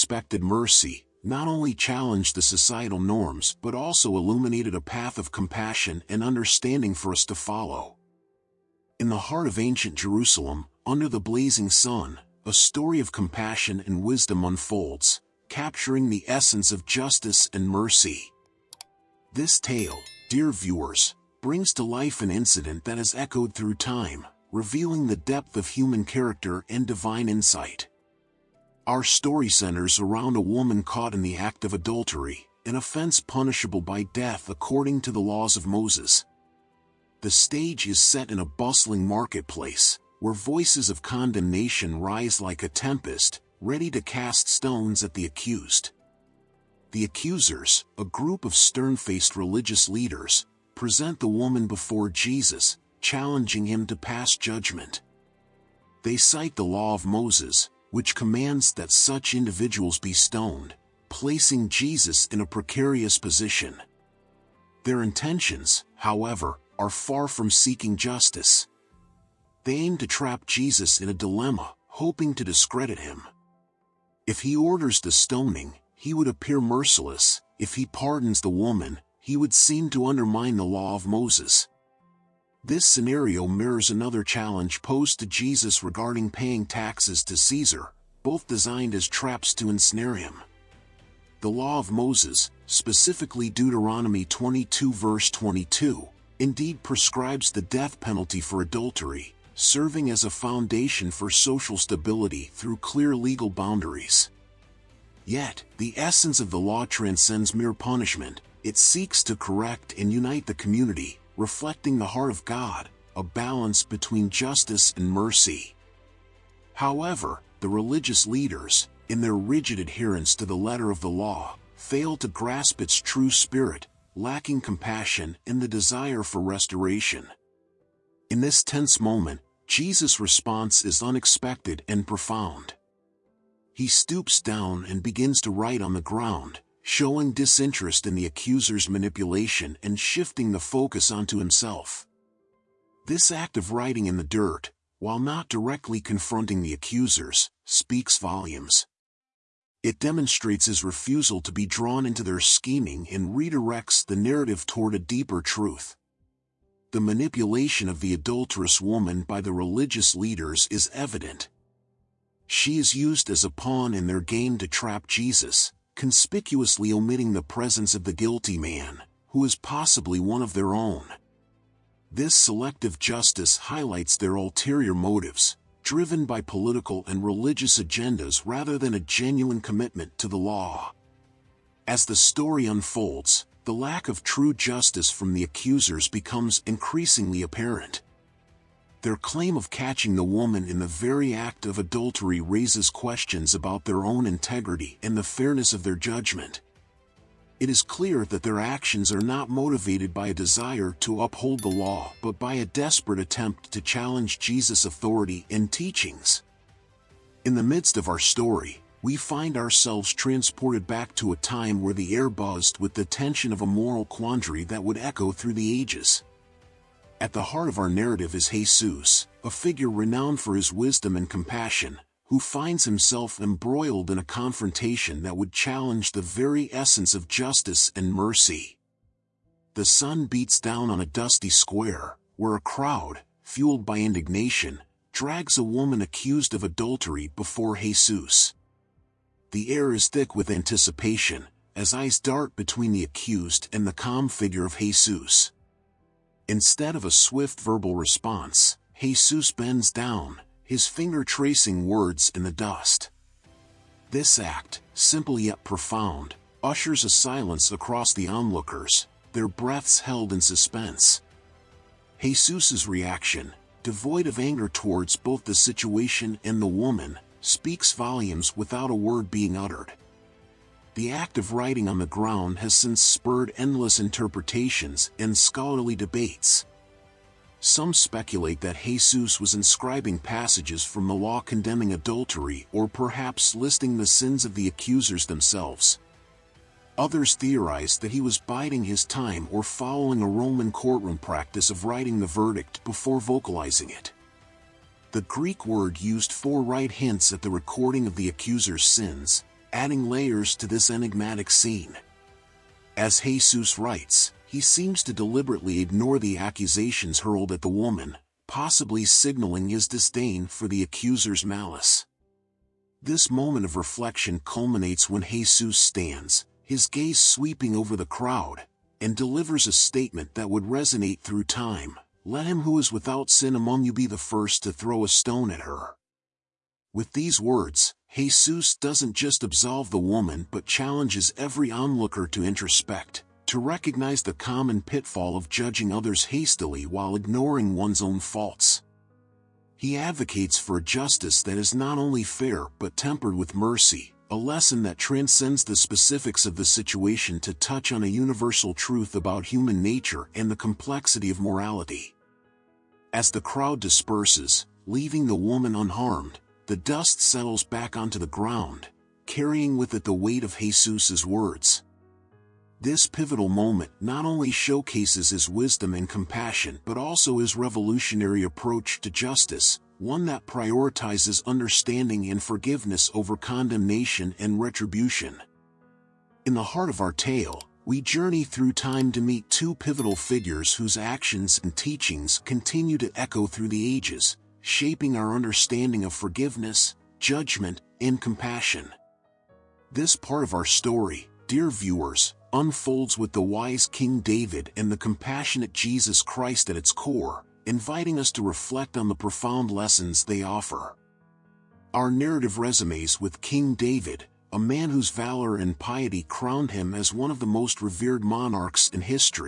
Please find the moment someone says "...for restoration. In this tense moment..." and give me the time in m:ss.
2:06.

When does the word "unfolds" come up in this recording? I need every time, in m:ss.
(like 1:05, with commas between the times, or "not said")
0:14, 3:02, 6:32.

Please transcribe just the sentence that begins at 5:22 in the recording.
Let him who is without sin among you be the first to throw a stone at her.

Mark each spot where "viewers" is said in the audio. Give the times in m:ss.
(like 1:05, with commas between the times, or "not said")
0:20, 6:31.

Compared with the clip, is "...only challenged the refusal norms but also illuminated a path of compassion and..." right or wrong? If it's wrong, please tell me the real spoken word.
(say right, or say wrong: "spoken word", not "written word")
wrong: "societal", not "refusal".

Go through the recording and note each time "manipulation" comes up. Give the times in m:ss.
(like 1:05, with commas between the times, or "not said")
2:18, 2:36.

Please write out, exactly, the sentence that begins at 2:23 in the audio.
This act of writing in the dirt, while not directly confronting the accusers, speaks volumes.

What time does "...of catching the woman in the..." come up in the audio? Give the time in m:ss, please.
3:09.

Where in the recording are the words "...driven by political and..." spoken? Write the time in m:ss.
2:55.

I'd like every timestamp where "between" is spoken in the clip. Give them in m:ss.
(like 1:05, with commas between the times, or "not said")
1:53, 4:02.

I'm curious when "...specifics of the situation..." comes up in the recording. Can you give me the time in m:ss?
5:45.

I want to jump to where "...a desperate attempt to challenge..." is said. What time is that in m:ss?
3:22.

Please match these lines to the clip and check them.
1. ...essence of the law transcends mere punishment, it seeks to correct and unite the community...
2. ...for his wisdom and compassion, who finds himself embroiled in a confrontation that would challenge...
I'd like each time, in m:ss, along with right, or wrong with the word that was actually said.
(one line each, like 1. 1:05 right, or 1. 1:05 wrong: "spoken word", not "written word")
1. 1:45 right
2. 3:40 right.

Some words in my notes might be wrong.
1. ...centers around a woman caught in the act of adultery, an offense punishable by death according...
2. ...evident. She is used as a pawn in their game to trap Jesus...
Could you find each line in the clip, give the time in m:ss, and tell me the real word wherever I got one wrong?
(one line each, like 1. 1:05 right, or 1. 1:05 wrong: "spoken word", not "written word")
1. 0:29 right
2. 2:40 right.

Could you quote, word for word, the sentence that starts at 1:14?
If he orders the stoning, he would appear merciless.